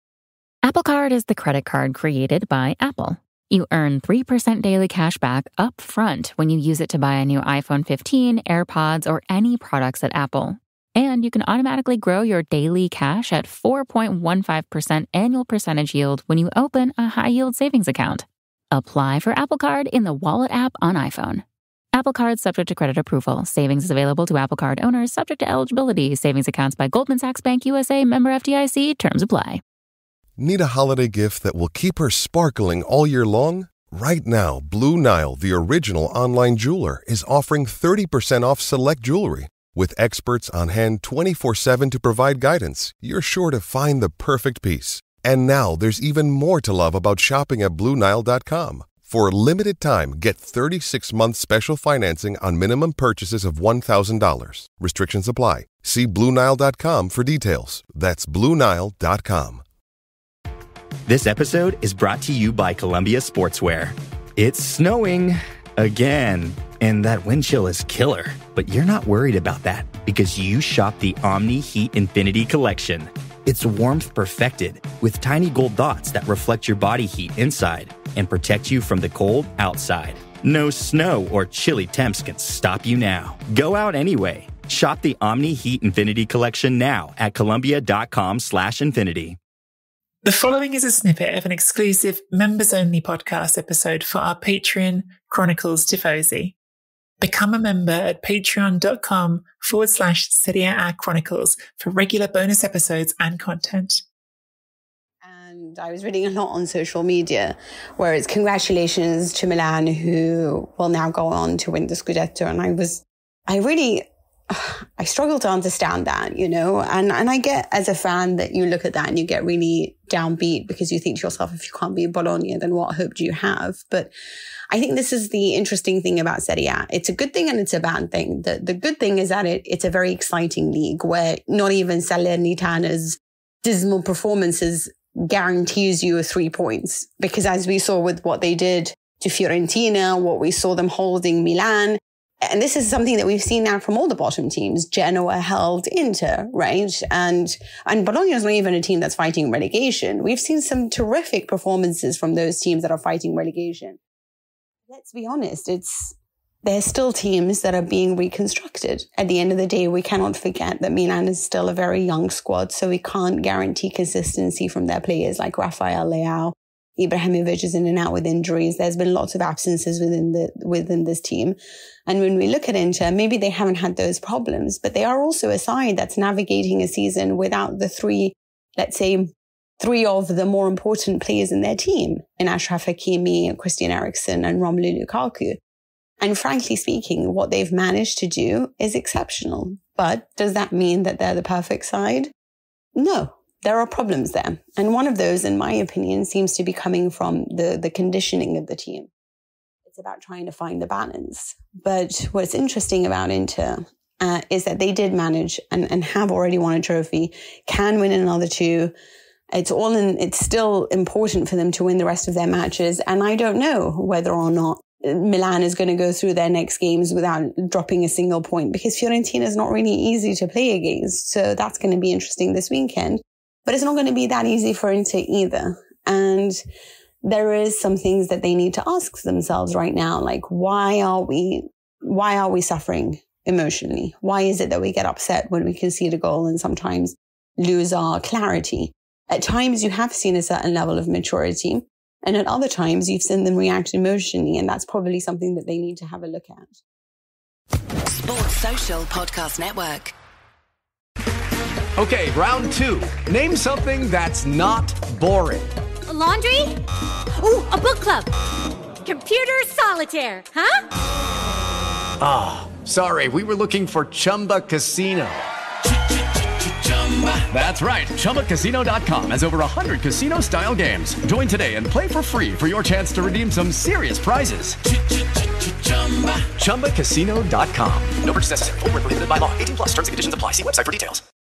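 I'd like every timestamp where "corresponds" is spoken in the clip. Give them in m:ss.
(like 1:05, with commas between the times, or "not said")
not said.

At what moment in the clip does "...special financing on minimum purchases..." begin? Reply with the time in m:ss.
0:51.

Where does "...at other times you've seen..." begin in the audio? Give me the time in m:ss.
4:02.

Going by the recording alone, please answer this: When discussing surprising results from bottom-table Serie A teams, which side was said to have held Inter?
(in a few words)
Genoa.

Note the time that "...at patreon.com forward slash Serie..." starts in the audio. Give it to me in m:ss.
1:37.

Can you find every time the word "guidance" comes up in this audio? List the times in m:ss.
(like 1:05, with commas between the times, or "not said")
0:42.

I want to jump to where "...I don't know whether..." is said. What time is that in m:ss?
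3:33.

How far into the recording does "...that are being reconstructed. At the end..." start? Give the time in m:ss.
2:37.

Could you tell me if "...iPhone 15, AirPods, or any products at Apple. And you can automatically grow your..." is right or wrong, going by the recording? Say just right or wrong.
right.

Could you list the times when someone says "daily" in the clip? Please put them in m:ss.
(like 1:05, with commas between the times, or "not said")
0:04, 0:12.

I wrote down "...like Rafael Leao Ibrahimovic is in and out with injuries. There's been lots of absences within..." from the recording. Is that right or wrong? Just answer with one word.
right.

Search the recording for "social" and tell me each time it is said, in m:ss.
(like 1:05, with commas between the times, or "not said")
1:46, 4:08.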